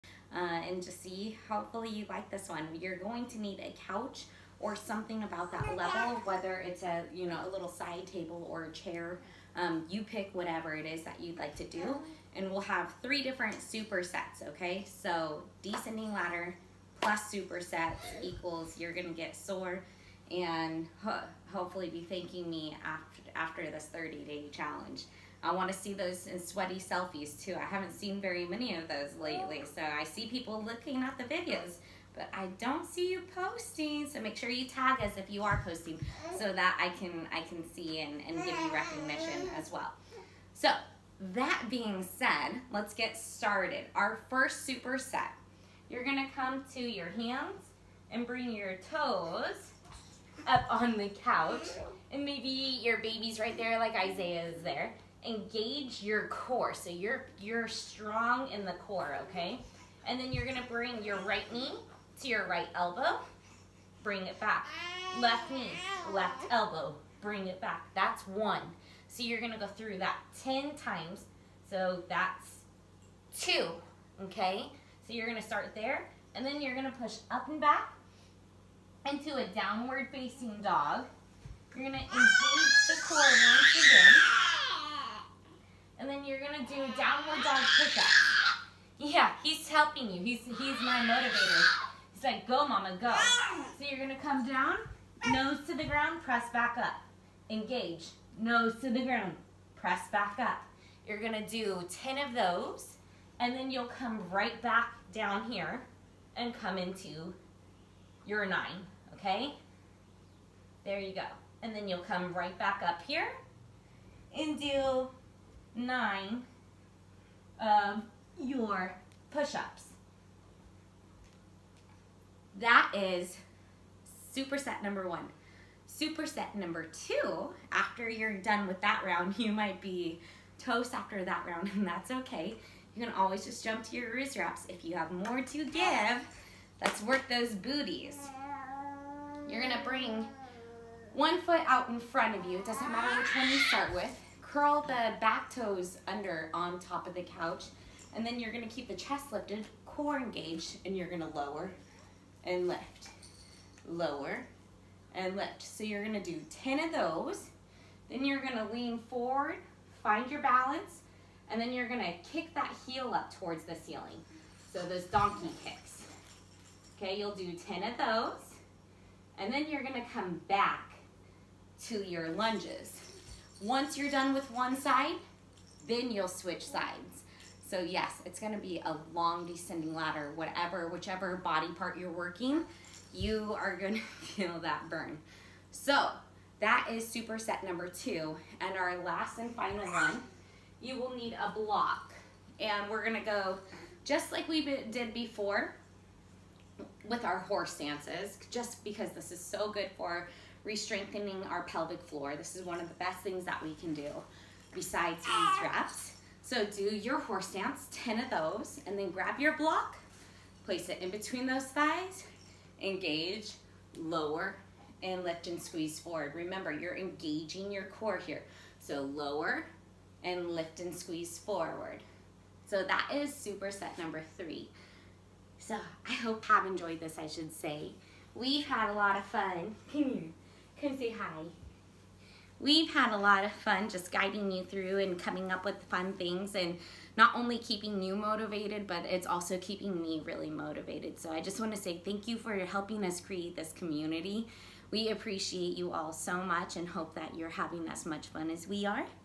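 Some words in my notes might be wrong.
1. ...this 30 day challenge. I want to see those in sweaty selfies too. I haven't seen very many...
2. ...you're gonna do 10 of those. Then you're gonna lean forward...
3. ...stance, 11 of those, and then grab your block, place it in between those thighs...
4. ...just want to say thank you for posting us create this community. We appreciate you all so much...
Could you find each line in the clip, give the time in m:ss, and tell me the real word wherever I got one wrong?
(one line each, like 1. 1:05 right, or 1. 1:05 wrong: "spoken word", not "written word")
1. 0:23 right
2. 2:35 right
3. 3:27 wrong: "10", not "11"
4. 4:01 wrong: "helping", not "posting".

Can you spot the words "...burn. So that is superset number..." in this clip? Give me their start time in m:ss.
3:04.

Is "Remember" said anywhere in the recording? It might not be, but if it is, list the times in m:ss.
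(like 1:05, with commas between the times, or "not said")
3:36.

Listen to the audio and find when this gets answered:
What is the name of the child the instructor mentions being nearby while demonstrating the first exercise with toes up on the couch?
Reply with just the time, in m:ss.
0:53.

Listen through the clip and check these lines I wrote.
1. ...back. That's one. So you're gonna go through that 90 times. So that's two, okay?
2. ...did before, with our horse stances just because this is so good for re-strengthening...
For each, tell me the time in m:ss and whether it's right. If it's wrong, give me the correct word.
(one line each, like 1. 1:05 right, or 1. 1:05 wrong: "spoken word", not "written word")
1. 1:07 wrong: "10", not "90"
2. 3:14 right.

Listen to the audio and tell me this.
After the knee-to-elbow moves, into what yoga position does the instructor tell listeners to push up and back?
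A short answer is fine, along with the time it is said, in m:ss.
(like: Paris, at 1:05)
Downward facing dog, at 1:19.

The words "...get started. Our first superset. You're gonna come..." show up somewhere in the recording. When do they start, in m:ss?
0:42.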